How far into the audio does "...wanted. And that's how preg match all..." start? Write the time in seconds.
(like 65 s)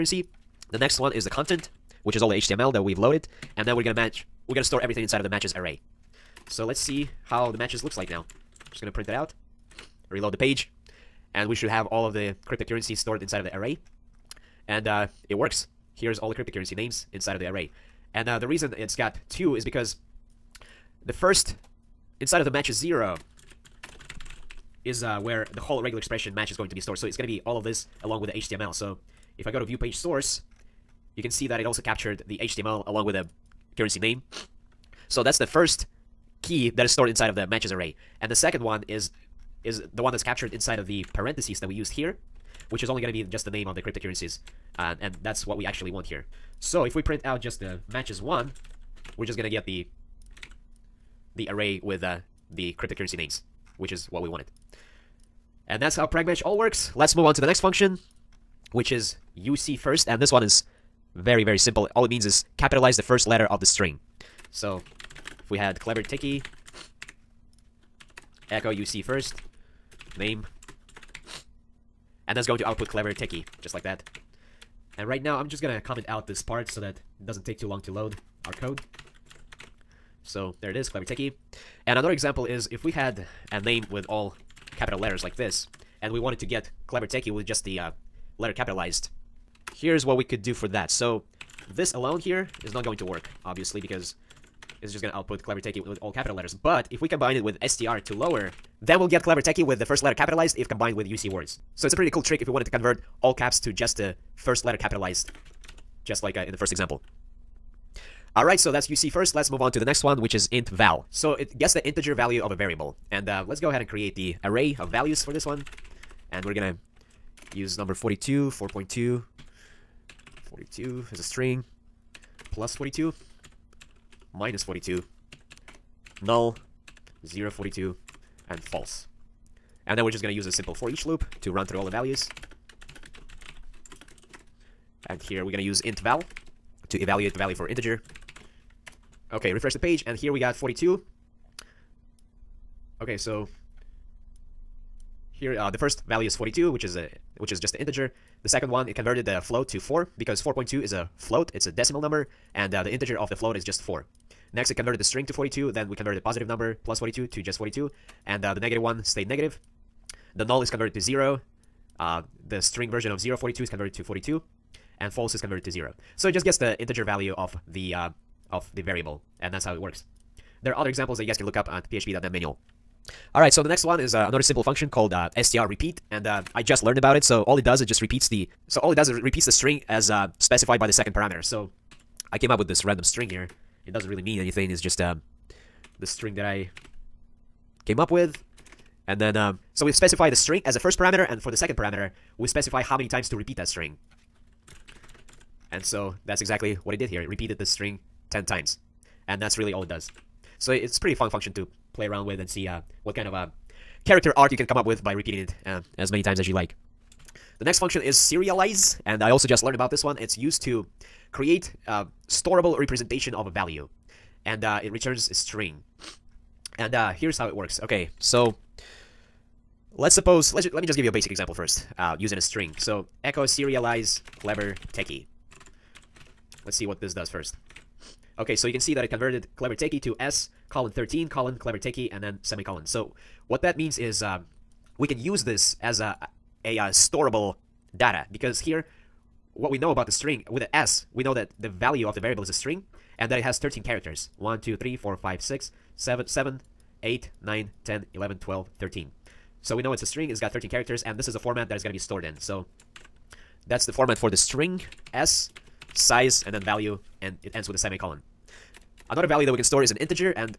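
54 s.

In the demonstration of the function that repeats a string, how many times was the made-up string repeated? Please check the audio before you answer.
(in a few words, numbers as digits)
10.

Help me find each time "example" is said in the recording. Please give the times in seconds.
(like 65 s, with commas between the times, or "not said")
82 s, 106 s, 170 s, 221 s.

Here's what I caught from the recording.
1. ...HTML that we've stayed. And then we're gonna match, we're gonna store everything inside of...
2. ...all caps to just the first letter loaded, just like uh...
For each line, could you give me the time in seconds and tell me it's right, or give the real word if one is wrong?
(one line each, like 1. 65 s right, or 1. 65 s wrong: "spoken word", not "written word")
1. 2 s wrong: "loaded", not "stayed"
2. 103 s wrong: "capitalized", not "loaded".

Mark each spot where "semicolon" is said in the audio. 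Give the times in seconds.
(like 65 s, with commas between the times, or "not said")
232 s, 257 s.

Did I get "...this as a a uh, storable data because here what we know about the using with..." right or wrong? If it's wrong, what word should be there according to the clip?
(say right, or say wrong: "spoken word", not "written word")
wrong: "string", not "using".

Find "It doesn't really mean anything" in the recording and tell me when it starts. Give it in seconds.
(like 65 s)
183 s.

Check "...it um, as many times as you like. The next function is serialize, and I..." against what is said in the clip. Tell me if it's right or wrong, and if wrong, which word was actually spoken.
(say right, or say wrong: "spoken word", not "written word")
right.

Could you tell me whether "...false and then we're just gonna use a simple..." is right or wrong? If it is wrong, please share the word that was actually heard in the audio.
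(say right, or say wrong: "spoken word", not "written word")
right.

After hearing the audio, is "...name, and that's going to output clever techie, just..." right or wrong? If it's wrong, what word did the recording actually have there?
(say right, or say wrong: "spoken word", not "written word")
right.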